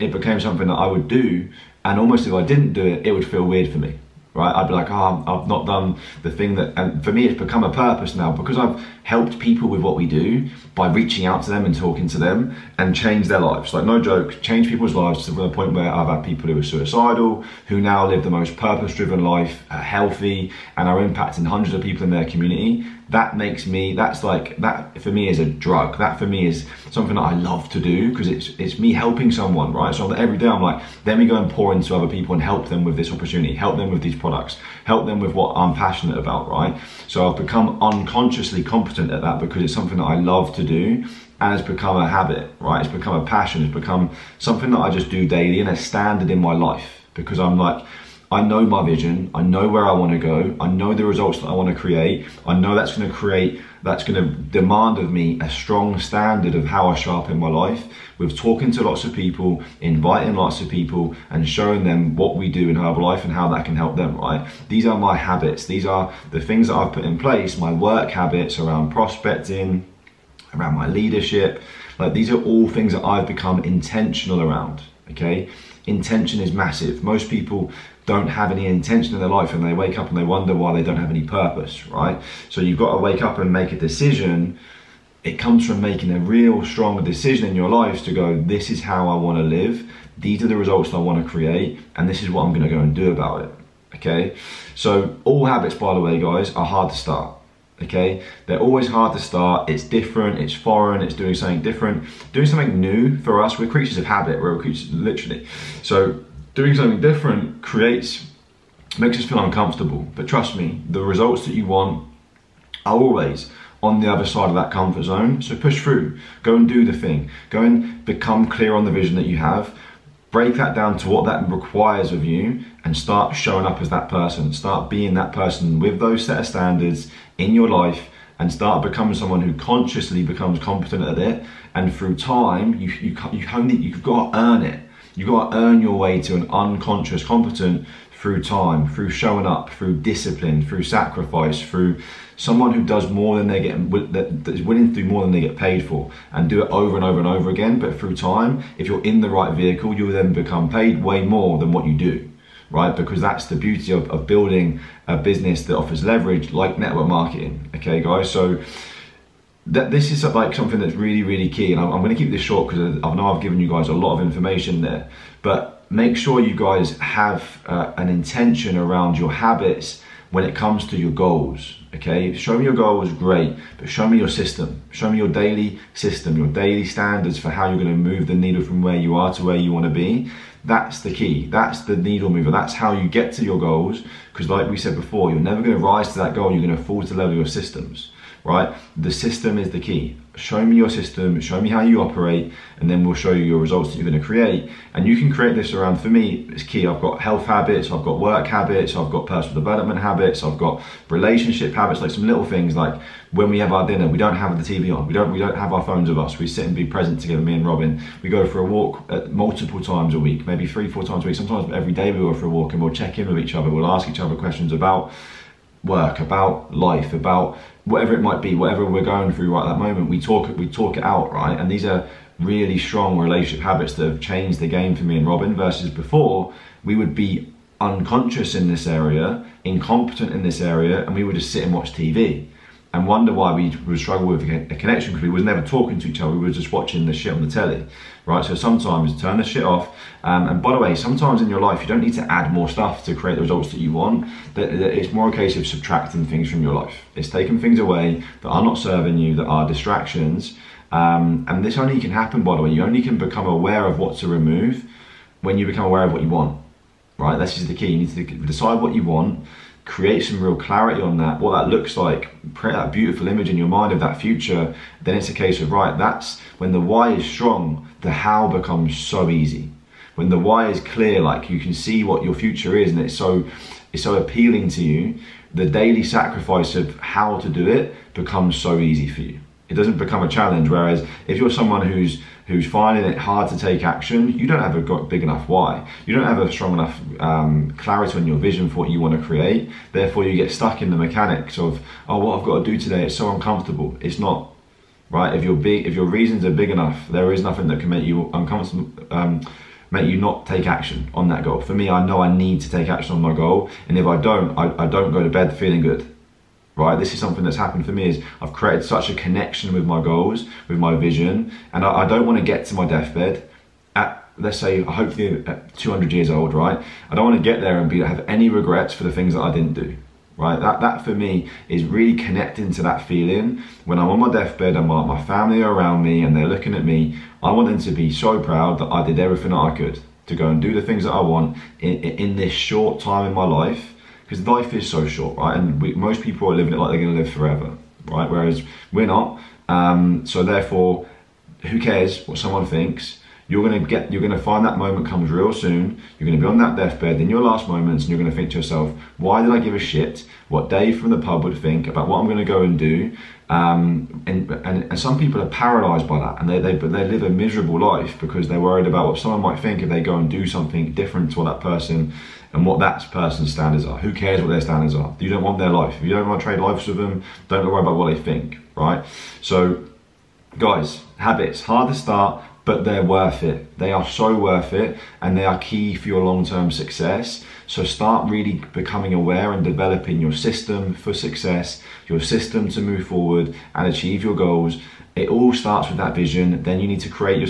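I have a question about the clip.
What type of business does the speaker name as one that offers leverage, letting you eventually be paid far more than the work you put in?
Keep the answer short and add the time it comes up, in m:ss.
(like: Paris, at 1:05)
network marketing, at 2:36.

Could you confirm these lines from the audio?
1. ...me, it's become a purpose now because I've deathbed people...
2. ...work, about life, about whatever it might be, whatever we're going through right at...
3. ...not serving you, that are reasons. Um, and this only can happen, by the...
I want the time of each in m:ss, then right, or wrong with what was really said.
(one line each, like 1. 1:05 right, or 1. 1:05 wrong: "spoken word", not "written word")
1. 0:07 wrong: "helped", not "deathbed"
2. 3:35 right
3. 4:08 wrong: "distractions", not "reasons".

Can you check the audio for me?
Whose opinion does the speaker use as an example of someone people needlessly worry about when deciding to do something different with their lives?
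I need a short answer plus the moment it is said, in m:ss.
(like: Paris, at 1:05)
Dave from the pub, at 5:50.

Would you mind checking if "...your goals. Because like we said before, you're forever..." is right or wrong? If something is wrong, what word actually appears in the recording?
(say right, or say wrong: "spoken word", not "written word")
wrong: "never", not "forever".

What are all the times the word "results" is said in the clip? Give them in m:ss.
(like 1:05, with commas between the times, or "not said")
0:51, 1:30, 1:51, 3:13, 4:03.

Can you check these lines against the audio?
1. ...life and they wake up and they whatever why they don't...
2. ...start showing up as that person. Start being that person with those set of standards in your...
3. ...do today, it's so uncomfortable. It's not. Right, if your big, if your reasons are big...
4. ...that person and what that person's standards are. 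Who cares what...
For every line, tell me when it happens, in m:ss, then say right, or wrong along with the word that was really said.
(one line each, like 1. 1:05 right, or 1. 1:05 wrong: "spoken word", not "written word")
1. 1:19 wrong: "wonder", not "whatever"
2. 2:02 right
3. 4:52 right
4. 6:01 right.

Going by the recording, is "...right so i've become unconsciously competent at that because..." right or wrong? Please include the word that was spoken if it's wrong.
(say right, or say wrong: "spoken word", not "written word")
right.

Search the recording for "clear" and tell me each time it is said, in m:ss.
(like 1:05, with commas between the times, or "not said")
1:58, 4:30.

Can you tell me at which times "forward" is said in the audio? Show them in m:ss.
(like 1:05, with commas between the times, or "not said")
6:23.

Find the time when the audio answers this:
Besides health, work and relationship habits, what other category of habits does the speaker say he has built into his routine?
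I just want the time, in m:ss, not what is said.
3:19.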